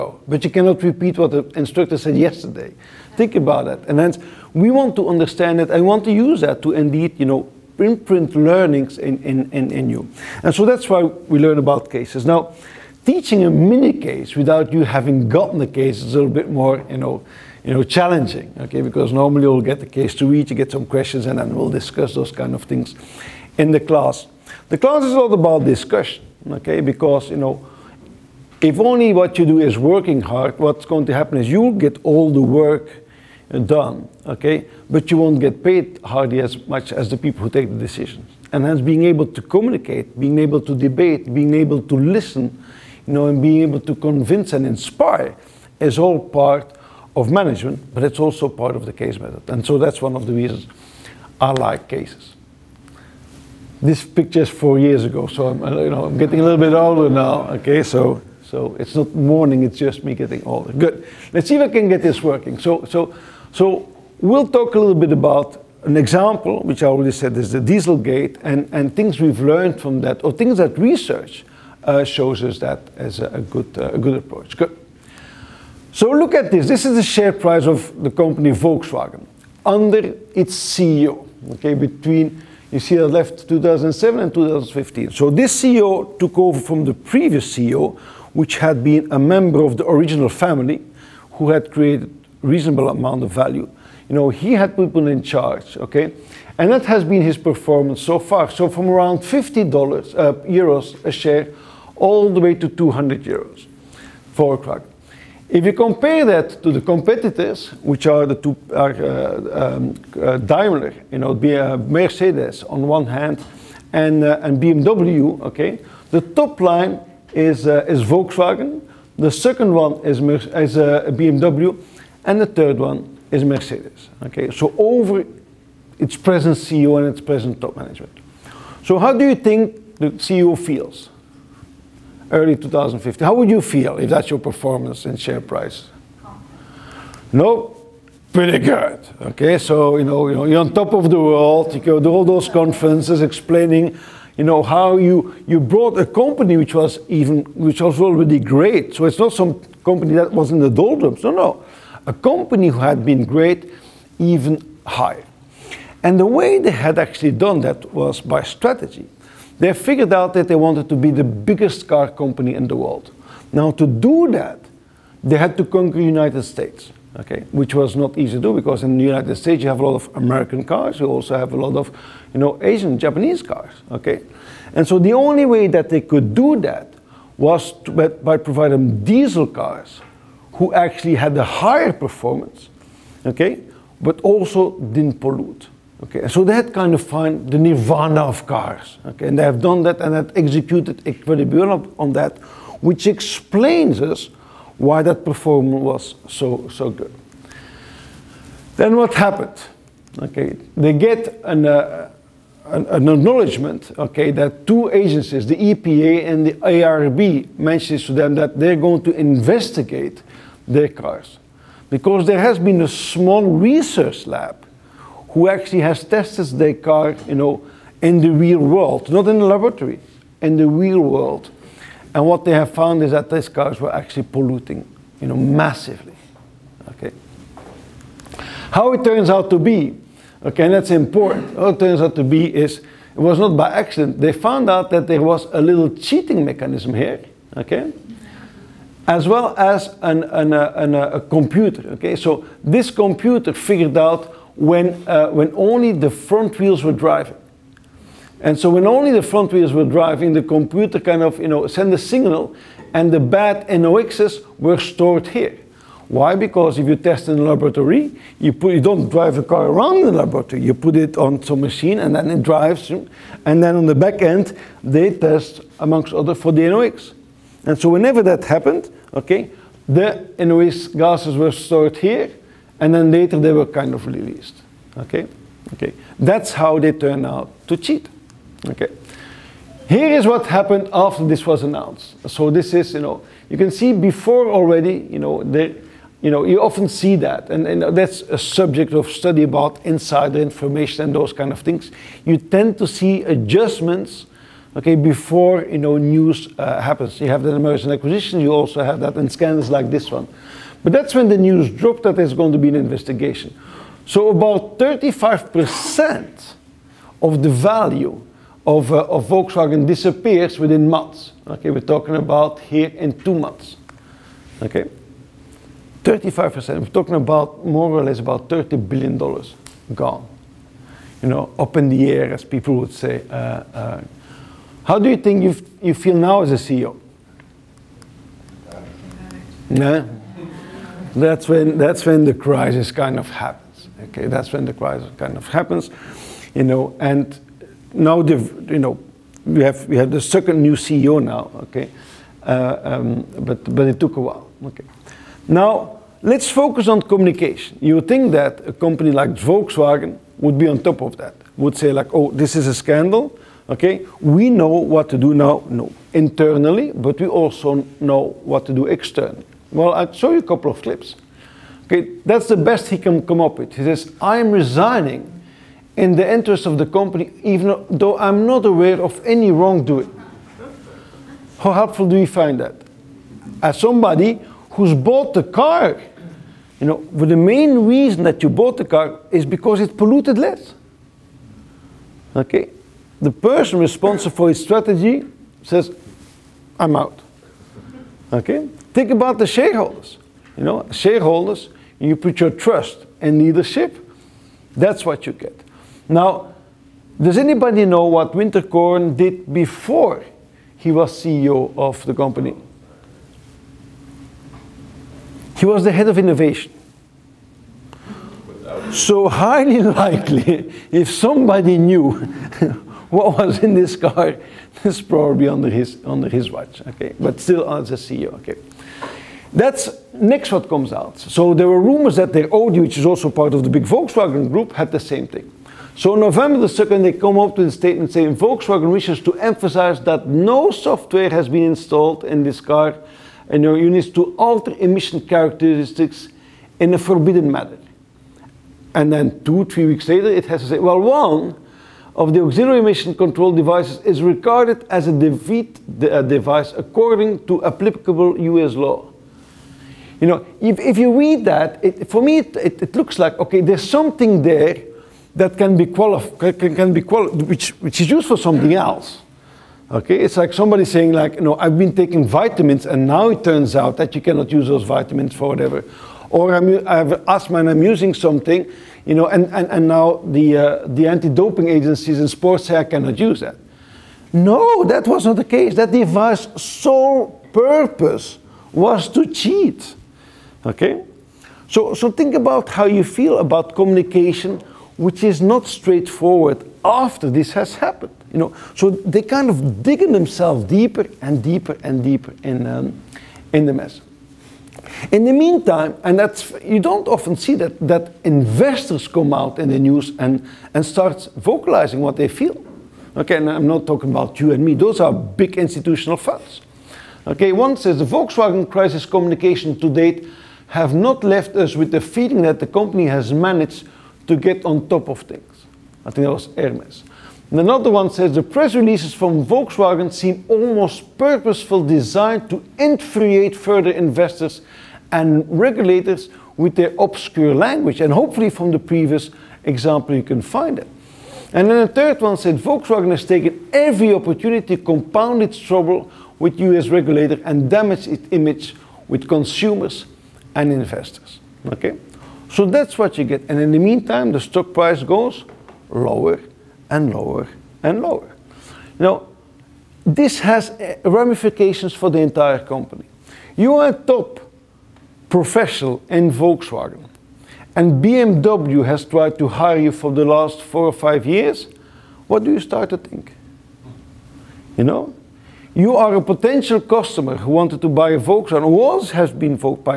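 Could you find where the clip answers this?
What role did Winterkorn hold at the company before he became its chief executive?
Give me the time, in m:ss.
6:45.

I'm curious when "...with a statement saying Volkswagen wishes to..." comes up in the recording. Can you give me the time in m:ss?
7:07.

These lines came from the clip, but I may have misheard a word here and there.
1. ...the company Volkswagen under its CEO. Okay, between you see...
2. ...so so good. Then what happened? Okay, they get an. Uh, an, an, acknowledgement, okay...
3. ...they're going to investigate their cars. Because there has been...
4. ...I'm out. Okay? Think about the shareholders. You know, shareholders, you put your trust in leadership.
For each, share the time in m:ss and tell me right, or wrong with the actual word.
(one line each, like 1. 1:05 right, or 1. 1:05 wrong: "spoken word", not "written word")
1. 1:18 right
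2. 3:16 right
3. 3:28 right
4. 6:26 right.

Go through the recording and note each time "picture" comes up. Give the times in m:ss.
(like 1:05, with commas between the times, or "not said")
0:54.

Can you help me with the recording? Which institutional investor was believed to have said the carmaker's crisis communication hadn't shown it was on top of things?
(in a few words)
Hermes.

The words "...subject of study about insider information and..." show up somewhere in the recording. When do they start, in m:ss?
4:48.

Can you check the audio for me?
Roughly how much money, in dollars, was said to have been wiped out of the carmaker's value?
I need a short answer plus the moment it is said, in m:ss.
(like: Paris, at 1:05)
30 billion dollars, at 5:18.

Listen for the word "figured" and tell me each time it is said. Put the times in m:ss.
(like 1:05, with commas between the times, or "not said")
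2:39, 4:03.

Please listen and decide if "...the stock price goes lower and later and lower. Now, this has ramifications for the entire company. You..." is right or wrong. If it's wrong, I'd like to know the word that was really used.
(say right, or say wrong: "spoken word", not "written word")
wrong: "lower", not "later".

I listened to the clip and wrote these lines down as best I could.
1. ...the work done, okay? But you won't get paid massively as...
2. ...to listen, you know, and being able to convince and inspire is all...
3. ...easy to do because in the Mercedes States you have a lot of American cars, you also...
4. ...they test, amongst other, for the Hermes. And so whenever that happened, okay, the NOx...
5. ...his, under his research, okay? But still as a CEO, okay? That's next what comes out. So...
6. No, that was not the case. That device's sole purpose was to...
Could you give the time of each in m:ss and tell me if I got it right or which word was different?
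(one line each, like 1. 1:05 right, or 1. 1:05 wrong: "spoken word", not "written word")
1. 0:32 wrong: "hardly", not "massively"
2. 0:41 right
3. 2:48 wrong: "United", not "Mercedes"
4. 4:24 wrong: "NOx", not "Hermes"
5. 6:55 wrong: "watch", not "research"
6. 7:54 right.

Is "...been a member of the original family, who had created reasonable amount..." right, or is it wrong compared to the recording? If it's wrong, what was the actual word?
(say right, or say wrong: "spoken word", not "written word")
right.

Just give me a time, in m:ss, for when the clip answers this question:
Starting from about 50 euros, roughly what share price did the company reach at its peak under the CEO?
1:42.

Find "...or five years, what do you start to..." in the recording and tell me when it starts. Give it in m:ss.
9:20.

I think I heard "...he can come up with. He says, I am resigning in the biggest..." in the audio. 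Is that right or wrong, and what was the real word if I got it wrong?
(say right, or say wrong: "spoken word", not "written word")
wrong: "interest", not "biggest".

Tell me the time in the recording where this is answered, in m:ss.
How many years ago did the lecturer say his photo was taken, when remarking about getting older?
0:54.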